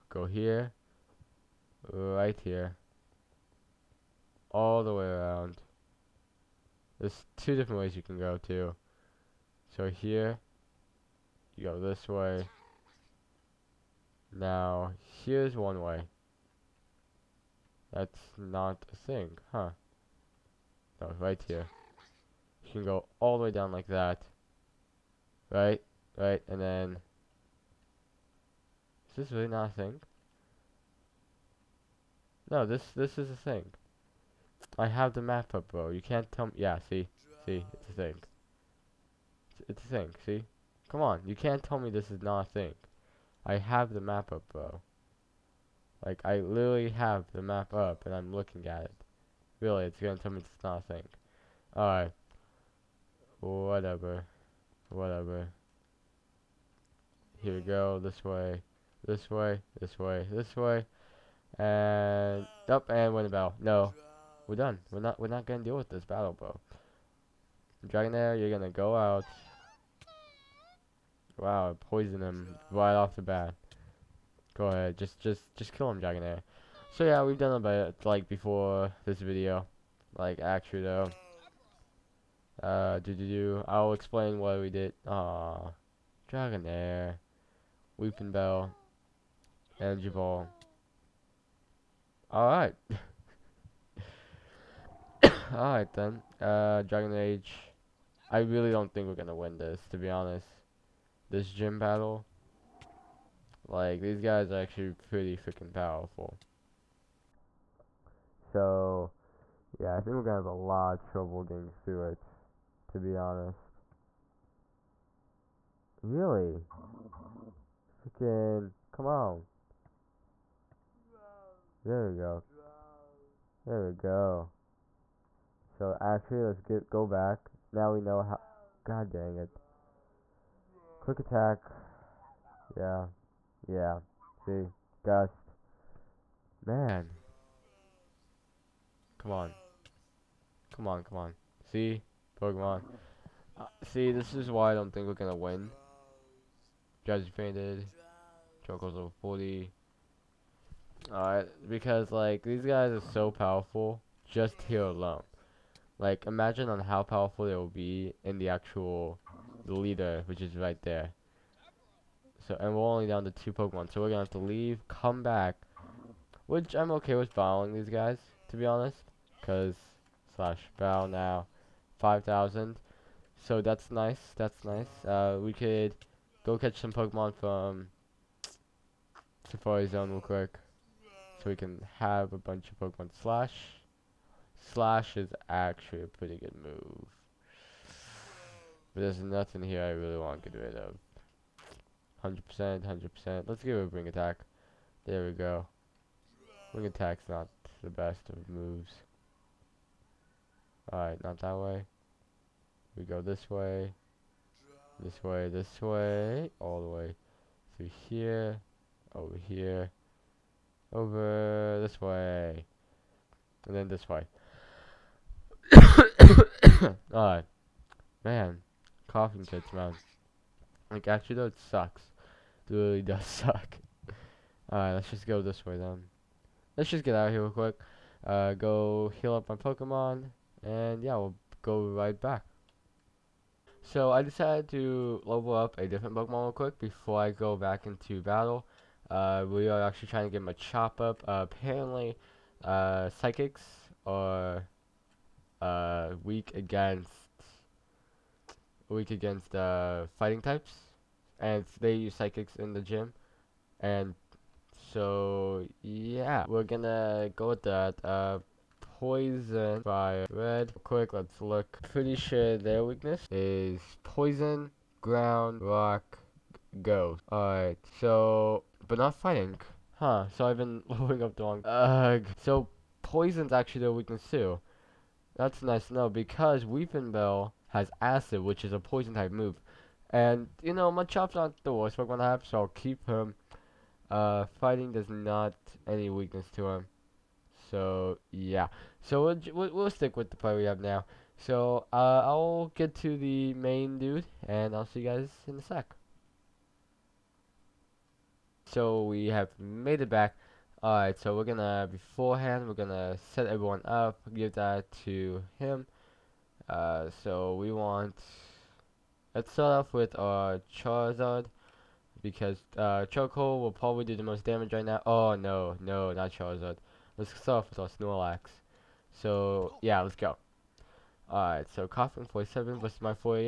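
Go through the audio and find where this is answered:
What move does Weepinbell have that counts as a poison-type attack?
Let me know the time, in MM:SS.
04:37.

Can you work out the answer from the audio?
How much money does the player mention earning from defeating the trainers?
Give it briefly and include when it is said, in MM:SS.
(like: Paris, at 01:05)
5000, at 02:51.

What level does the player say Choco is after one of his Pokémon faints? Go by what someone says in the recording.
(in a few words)
40.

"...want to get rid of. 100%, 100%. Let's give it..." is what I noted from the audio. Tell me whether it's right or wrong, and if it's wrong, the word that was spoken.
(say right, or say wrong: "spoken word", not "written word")
right.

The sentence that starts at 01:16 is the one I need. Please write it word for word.
So yeah, we've done about like before this video, like actually though.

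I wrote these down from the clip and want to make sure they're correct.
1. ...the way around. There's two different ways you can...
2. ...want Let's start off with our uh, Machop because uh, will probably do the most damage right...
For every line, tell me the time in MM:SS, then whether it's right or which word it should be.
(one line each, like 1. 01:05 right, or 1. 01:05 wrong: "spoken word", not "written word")
1. 00:04 right
2. 05:07 wrong: "Charizard", not "Machop".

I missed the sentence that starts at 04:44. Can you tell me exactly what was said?
Uh, fighting does not any weakness to him.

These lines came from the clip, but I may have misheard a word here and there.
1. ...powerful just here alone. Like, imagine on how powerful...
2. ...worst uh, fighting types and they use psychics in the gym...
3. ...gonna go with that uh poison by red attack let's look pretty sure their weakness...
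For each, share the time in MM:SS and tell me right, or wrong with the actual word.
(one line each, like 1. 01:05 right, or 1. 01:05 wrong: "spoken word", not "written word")
1. 02:33 right
2. 04:09 wrong: "against", not "worst"
3. 04:16 wrong: "quick", not "attack".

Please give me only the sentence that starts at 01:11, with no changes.
Wow, poison him right off the bat.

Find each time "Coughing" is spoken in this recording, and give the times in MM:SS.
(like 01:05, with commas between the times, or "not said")
03:39.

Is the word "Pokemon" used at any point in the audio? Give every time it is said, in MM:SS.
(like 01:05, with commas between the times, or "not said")
02:22, 02:43, 02:56, 03:02, 03:49, 03:56.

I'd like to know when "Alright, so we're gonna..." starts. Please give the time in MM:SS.
05:00.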